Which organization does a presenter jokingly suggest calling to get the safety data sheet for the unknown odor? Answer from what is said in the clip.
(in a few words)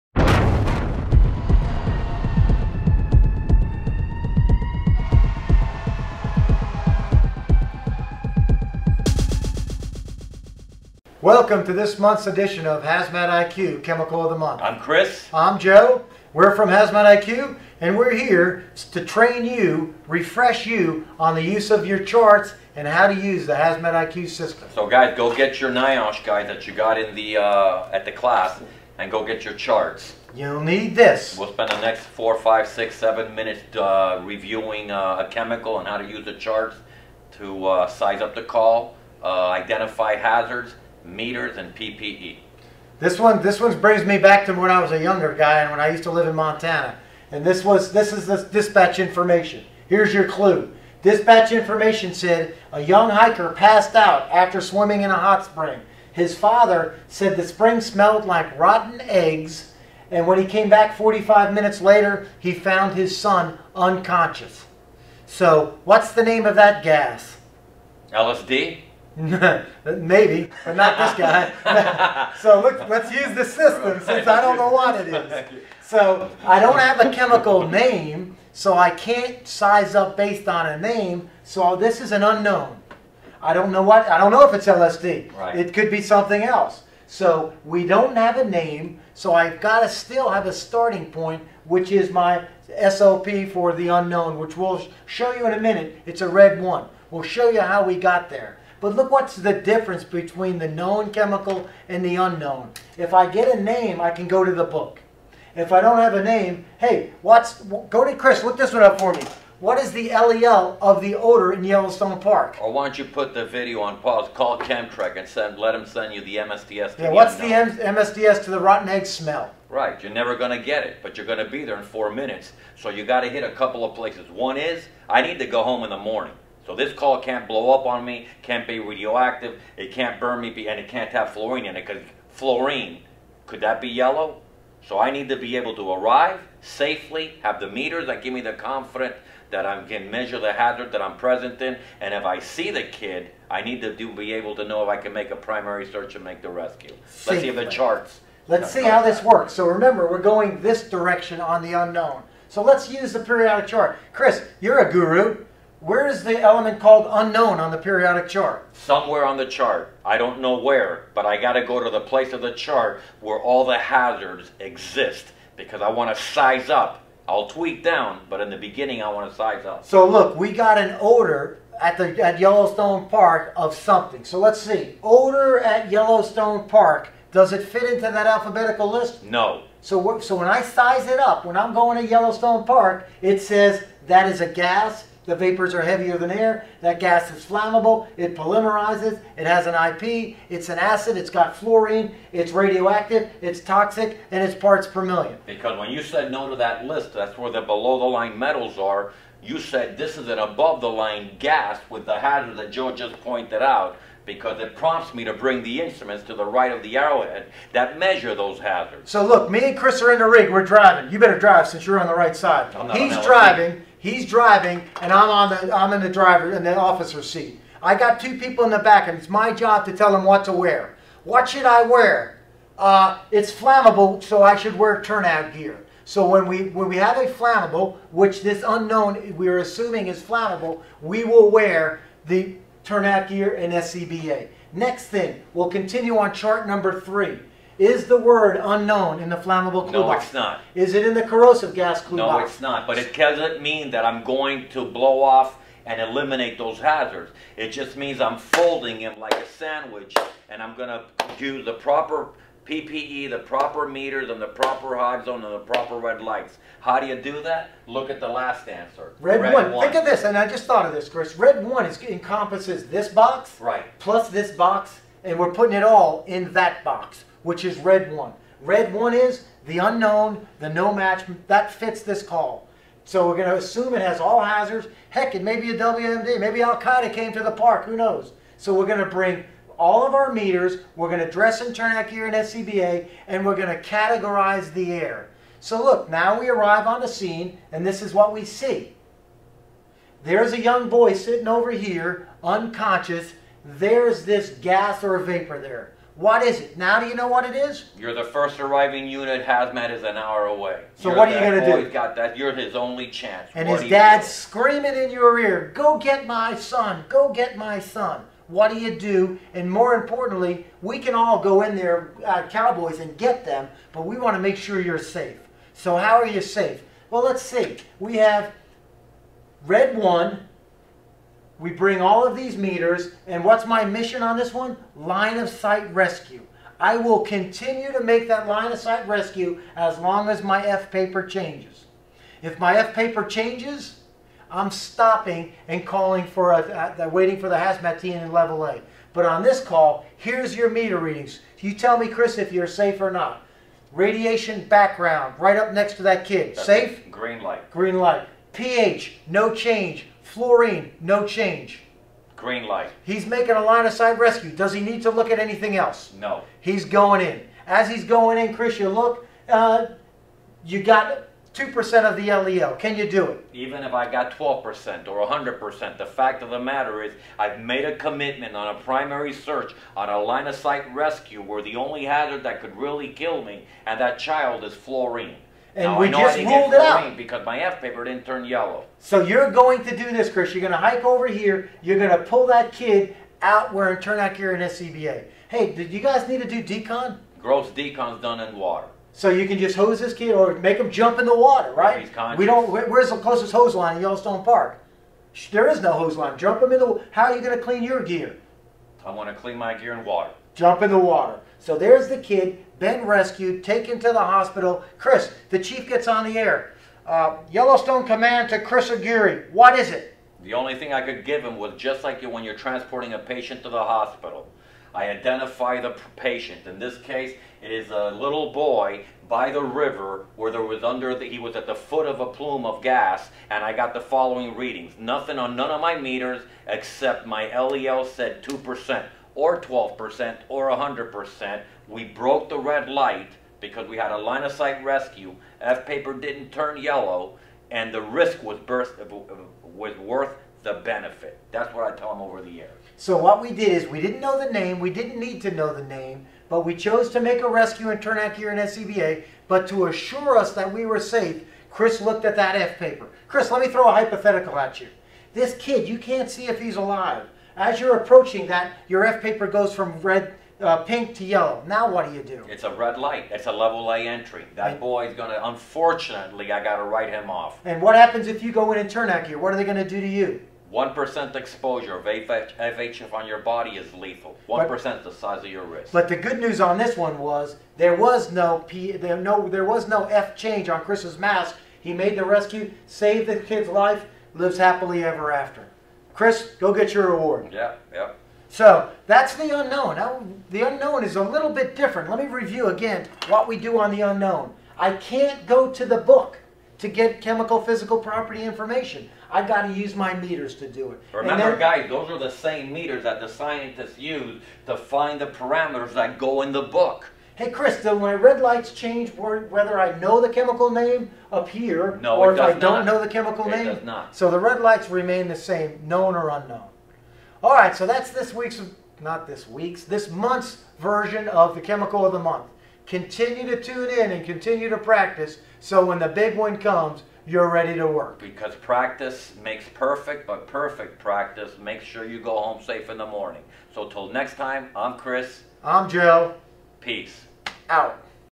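CHEMTREC.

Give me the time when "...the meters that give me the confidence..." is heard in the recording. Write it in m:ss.
2:17.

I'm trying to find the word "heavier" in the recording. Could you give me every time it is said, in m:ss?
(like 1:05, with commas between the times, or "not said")
3:05.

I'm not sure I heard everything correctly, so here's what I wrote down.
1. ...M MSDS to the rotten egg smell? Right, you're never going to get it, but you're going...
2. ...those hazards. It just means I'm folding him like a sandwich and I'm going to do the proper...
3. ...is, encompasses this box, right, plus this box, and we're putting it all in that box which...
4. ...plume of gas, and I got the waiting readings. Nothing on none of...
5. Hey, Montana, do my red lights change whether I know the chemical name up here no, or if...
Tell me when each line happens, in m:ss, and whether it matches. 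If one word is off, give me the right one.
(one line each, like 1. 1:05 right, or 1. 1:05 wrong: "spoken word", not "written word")
1. 1:57 right
2. 4:06 right
3. 4:21 right
4. 7:02 wrong: "following", not "waiting"
5. 8:27 wrong: "Chris", not "Montana".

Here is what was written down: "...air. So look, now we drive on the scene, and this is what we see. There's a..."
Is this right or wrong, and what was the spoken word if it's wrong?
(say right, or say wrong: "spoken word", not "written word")
wrong: "arrive", not "drive".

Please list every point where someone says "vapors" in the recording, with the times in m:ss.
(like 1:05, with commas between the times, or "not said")
3:05, 4:55.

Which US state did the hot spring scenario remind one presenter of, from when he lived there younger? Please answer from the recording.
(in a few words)
Montana.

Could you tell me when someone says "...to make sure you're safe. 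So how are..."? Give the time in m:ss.
5:14.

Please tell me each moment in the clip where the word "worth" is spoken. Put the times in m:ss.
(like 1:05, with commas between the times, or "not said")
7:19.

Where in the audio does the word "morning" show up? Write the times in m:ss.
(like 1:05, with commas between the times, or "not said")
2:05, 8:53.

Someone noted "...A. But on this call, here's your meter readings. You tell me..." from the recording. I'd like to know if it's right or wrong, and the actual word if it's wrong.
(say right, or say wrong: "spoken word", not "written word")
right.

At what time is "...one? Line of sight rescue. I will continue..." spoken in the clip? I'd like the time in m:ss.
5:24.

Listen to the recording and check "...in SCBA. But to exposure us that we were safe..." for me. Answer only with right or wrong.
wrong.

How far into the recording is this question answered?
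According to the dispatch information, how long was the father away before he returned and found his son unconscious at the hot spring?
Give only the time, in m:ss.
1:00.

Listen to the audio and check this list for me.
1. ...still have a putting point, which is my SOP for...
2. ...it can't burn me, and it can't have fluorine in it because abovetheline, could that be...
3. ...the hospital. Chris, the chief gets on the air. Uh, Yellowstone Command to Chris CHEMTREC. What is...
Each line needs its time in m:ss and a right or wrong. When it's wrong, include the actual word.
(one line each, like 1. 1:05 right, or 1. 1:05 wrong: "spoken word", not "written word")
1. 1:29 wrong: "starting", not "putting"
2. 2:09 wrong: "fluorine", not "abovetheline"
3. 6:44 wrong: "Aguirre", not "CHEMTREC".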